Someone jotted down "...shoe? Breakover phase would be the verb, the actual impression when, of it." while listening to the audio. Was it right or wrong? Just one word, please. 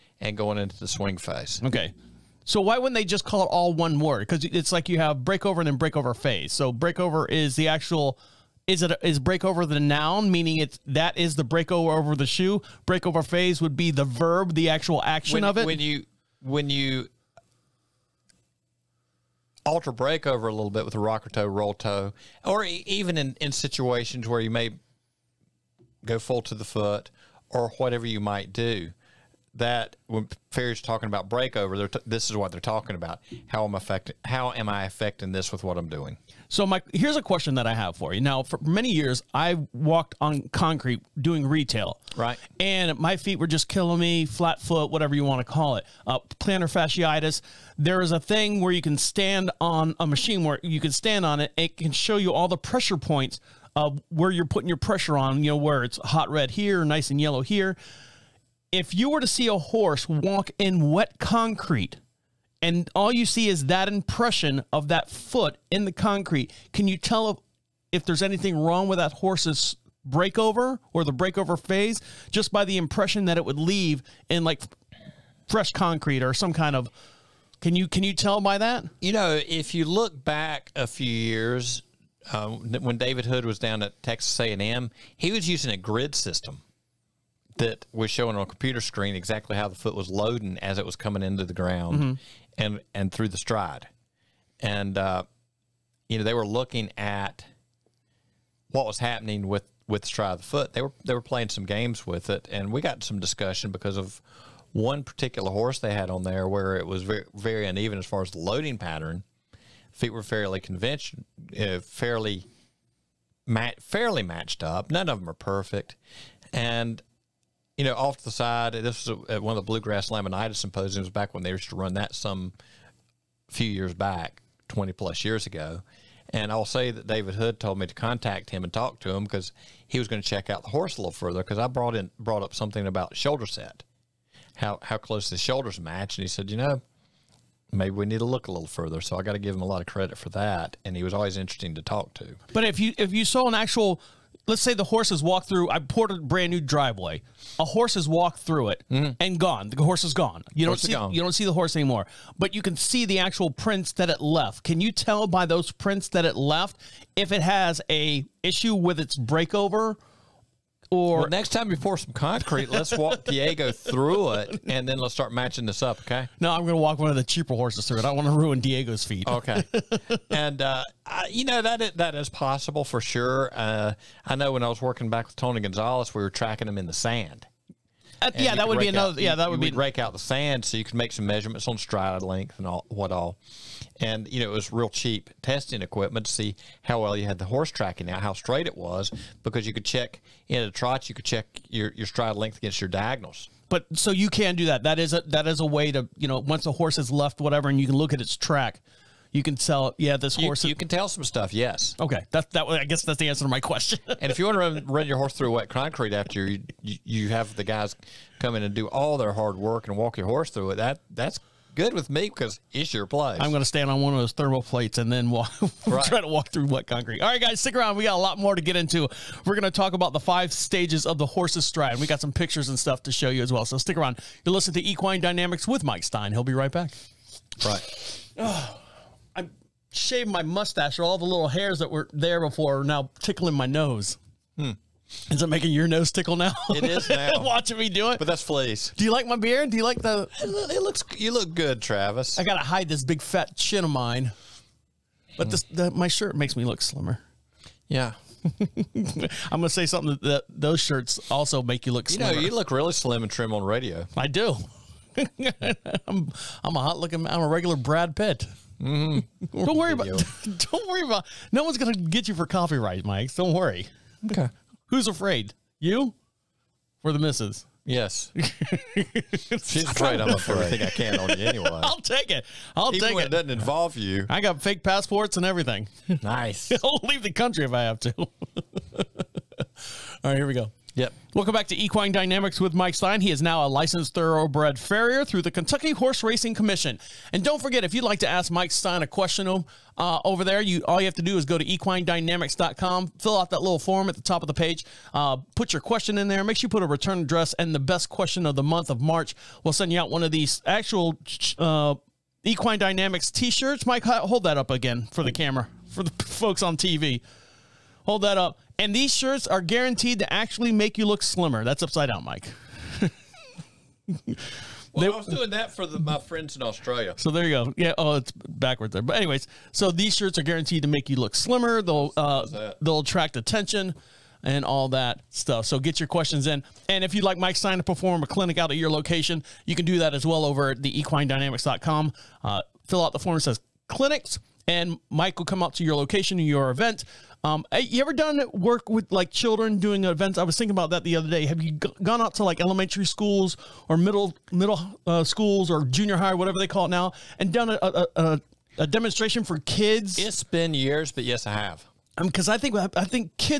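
wrong.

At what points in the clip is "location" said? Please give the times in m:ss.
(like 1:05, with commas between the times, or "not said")
5:28, 5:35.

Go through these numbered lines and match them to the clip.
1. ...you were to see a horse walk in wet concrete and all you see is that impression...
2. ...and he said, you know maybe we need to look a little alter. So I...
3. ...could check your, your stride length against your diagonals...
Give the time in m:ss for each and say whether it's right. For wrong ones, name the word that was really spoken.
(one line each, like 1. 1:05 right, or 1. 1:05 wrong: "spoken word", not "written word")
1. 0:58 right
2. 2:16 wrong: "further", not "alter"
3. 3:11 right.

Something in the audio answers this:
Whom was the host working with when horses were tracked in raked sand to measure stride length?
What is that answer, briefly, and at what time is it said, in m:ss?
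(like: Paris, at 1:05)
Tony Gonzalez, at 2:55.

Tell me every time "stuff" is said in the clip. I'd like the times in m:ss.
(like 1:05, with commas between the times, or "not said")
3:21, 3:42, 5:25.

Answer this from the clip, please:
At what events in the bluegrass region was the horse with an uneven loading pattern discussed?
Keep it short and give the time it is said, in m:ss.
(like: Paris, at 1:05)
laminitis symposiums, at 2:00.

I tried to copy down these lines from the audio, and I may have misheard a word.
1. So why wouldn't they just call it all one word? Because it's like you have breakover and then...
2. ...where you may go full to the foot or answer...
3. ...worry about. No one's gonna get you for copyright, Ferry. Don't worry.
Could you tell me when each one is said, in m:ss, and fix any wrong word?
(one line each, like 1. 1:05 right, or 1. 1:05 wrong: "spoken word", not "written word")
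1. 0:02 right
2. 0:24 wrong: "whatever", not "answer"
3. 4:20 wrong: "Mike", not "Ferry".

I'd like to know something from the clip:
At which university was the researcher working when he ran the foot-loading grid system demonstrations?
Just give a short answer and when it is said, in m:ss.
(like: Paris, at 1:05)
Texas A&M, at 1:24.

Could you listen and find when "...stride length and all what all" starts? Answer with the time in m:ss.
3:01.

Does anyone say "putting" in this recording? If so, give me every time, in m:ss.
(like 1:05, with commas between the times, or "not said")
0:54.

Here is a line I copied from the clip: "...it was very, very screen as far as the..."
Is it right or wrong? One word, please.
wrong.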